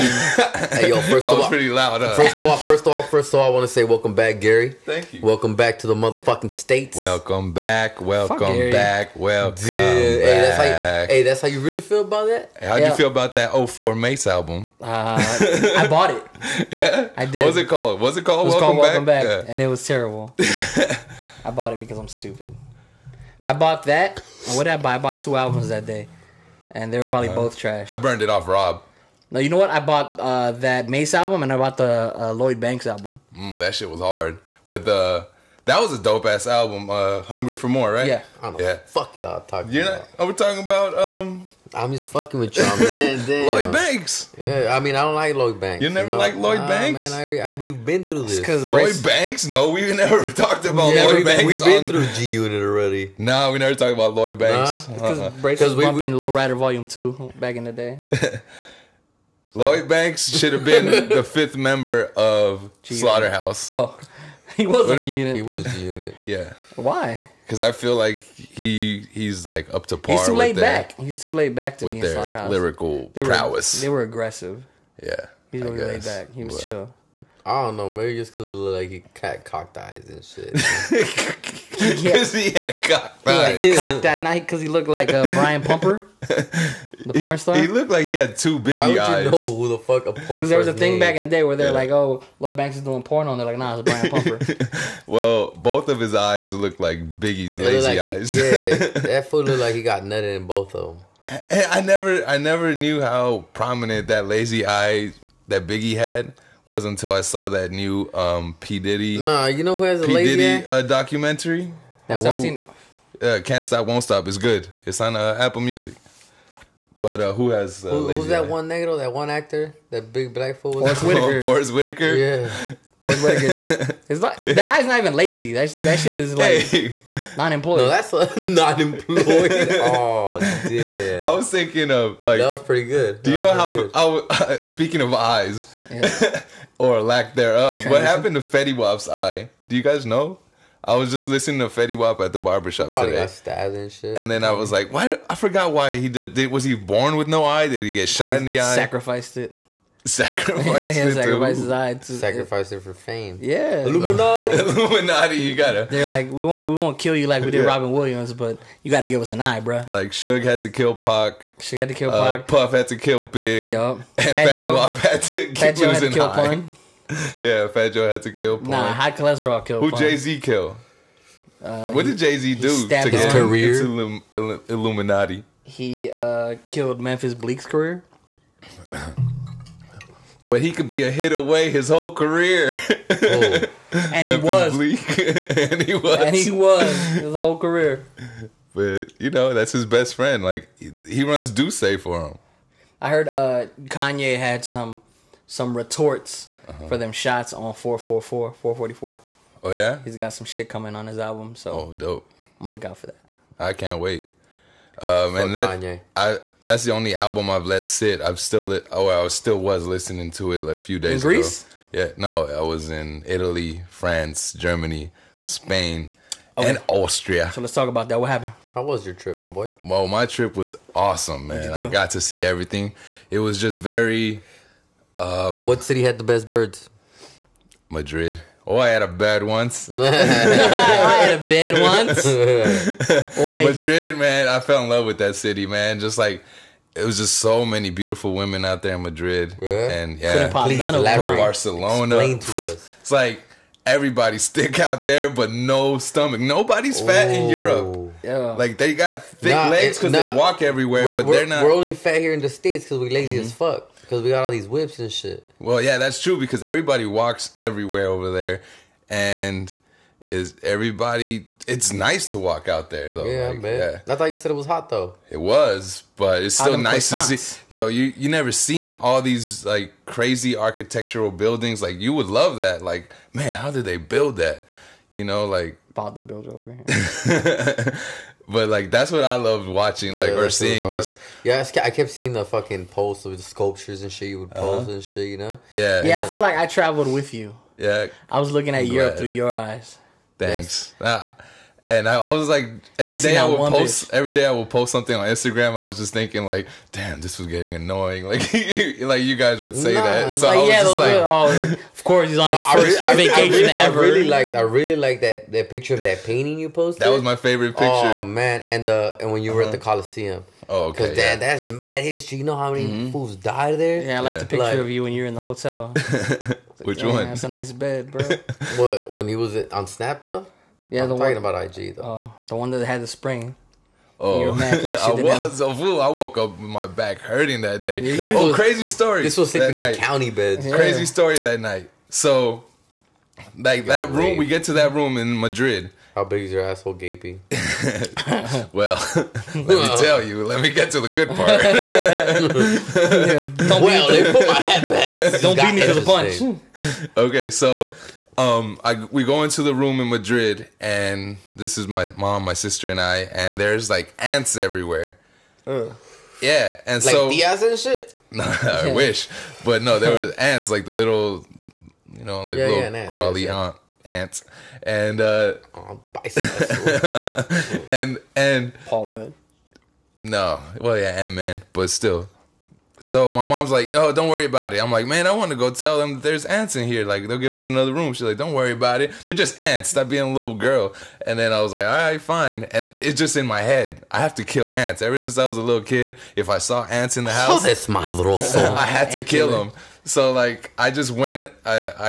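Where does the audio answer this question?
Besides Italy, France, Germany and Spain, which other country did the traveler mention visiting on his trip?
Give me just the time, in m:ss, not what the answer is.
3:36.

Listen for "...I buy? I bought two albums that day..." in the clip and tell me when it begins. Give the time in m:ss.
0:24.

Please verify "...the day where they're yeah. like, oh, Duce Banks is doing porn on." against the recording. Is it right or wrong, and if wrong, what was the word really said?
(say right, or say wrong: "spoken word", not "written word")
wrong: "Lloyd", not "Duce".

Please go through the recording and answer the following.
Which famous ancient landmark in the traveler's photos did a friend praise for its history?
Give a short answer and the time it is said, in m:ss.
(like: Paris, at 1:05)
Coliseum, at 5:09.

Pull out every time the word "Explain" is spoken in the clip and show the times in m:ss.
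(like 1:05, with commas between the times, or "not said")
4:02.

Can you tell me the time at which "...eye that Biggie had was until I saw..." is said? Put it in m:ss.
1:44.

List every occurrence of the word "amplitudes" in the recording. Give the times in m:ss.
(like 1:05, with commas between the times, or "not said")
not said.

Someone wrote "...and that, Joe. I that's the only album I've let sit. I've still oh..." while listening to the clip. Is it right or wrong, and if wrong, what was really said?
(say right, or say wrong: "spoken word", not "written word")
wrong: "Kanye", not "Joe".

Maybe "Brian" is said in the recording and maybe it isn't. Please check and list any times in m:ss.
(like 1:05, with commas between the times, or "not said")
1:25, 1:33.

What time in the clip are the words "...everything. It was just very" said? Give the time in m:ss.
3:42.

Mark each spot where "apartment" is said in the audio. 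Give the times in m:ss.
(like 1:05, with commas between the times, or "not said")
not said.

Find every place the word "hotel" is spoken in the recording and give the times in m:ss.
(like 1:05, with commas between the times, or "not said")
5:15.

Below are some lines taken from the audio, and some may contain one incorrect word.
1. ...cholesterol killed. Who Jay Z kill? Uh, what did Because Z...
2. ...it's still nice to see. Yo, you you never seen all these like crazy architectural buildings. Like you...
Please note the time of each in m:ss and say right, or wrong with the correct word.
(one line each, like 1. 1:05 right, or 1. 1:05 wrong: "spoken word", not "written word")
1. 2:49 wrong: "Jay", not "Because"
2. 4:26 right.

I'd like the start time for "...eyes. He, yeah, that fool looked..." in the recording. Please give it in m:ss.
1:37.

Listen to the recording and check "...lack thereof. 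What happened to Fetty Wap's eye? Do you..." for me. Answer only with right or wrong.
right.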